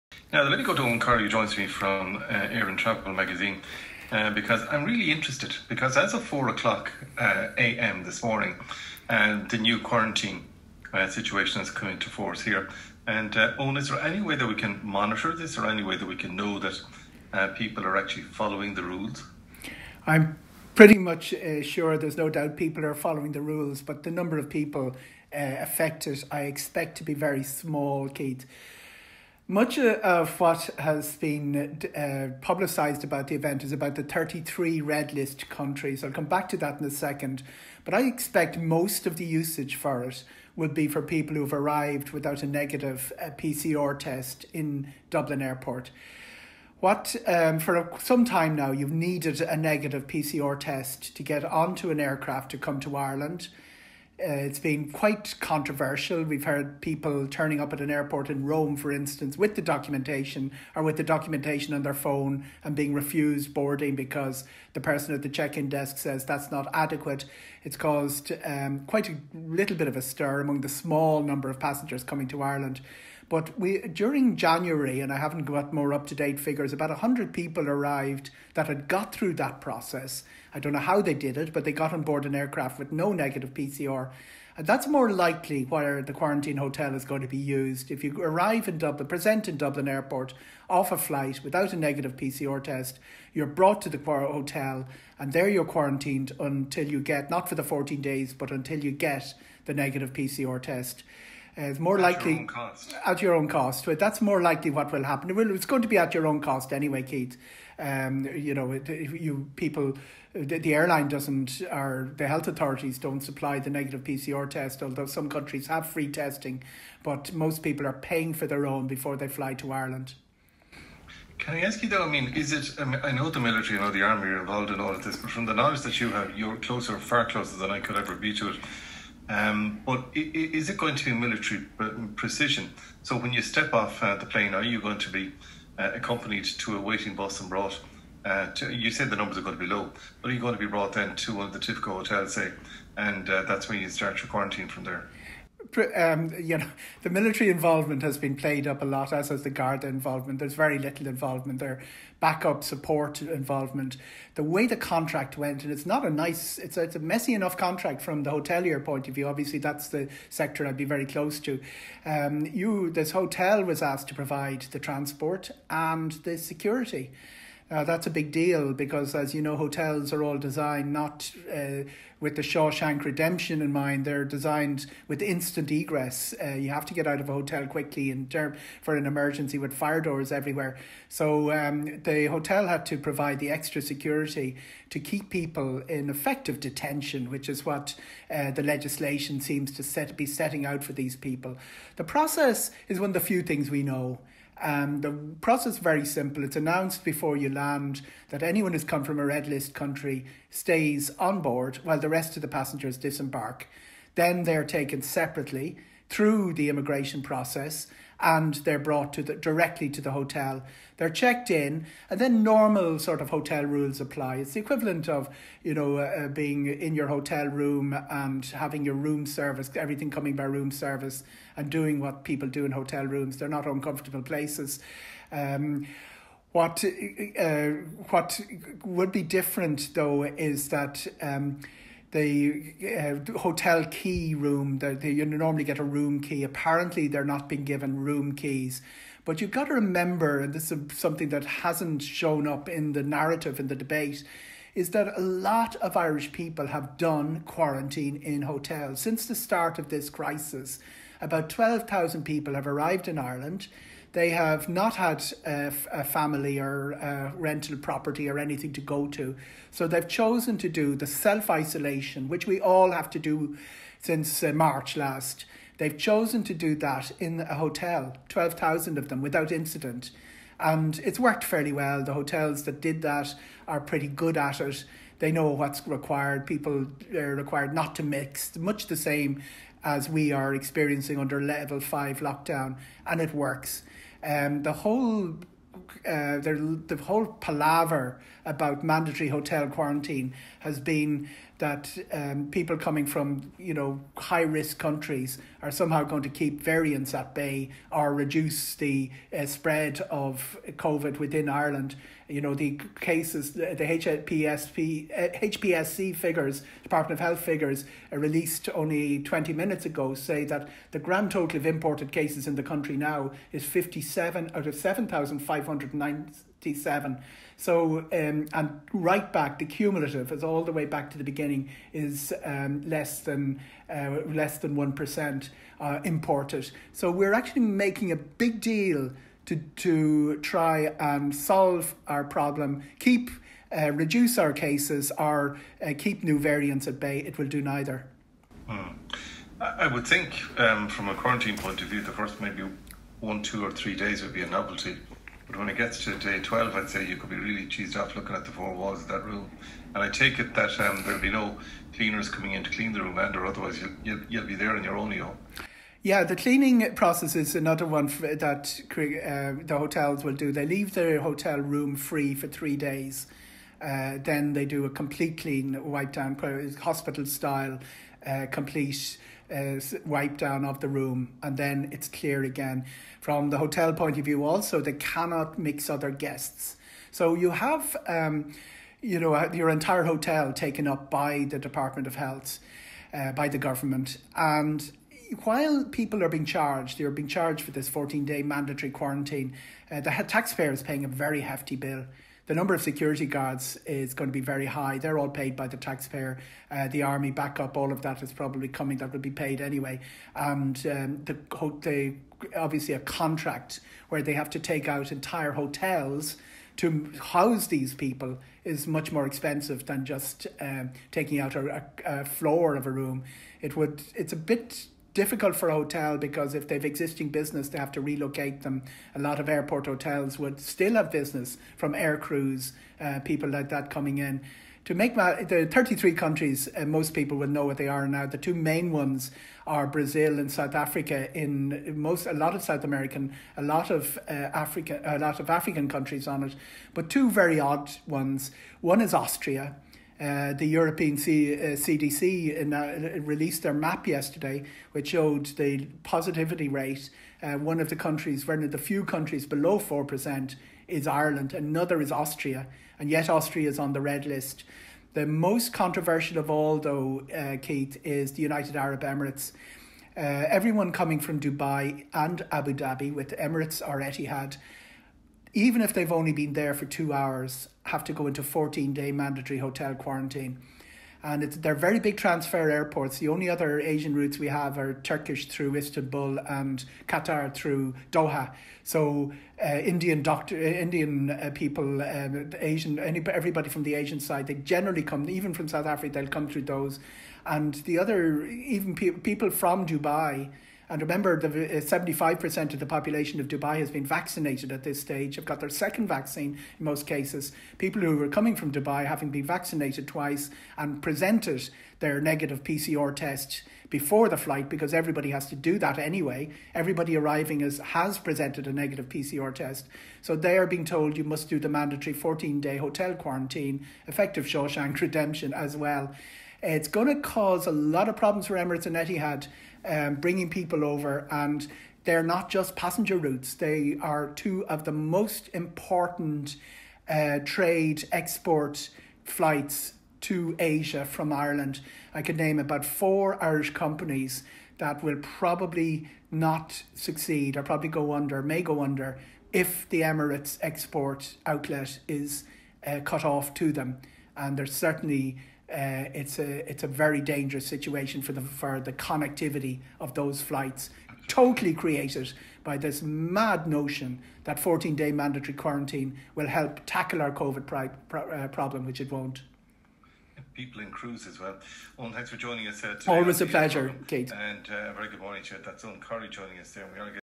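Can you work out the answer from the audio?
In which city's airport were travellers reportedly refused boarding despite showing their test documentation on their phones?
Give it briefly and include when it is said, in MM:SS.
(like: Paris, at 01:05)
Rome, at 00:58.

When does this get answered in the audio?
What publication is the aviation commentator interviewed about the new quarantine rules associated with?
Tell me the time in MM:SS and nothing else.
00:02.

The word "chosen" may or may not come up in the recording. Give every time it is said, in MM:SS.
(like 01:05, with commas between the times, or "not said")
04:20, 04:25.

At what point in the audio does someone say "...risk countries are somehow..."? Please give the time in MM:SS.
04:54.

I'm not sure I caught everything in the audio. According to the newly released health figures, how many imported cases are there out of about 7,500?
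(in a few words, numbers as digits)
57.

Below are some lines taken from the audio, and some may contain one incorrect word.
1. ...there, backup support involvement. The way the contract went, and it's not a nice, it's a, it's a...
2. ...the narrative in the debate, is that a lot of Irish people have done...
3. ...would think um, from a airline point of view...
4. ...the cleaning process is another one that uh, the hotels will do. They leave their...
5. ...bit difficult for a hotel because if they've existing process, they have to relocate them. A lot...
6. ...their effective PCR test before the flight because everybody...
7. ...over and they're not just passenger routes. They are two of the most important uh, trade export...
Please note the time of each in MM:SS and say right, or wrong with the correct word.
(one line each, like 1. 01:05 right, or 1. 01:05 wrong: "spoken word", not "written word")
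1. 02:31 right
2. 04:02 right
3. 05:39 wrong: "quarantine", not "airline"
4. 05:56 right
5. 06:54 wrong: "business", not "process"
6. 08:22 wrong: "negative", not "effective"
7. 08:40 right.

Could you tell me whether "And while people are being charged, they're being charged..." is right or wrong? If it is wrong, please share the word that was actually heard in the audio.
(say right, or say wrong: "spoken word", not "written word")
right.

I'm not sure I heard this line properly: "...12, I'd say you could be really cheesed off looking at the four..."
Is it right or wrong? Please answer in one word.
right.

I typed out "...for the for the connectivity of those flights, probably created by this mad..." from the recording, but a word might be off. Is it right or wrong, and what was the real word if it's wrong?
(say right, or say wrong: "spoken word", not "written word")
wrong: "totally", not "probably".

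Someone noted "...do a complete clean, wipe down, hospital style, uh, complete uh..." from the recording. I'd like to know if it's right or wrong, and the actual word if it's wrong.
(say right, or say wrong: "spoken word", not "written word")
right.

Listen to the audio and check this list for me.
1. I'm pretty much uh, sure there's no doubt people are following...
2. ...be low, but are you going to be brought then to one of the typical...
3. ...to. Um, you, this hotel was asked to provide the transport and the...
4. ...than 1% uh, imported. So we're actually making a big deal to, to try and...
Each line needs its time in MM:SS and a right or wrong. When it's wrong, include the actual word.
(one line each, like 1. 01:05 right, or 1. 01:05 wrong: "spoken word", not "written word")
1. 00:20 right
2. 02:19 right
3. 02:41 right
4. 05:24 right.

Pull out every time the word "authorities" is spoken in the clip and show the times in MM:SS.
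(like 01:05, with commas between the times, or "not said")
01:52.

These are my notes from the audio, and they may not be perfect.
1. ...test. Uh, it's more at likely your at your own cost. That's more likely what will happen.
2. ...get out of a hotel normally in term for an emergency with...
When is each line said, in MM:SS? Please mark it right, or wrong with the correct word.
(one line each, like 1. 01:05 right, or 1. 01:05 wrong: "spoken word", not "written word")
1. 01:40 right
2. 02:56 wrong: "quickly", not "normally".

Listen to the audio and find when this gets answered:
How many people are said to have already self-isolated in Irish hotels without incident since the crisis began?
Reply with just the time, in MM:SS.
04:28.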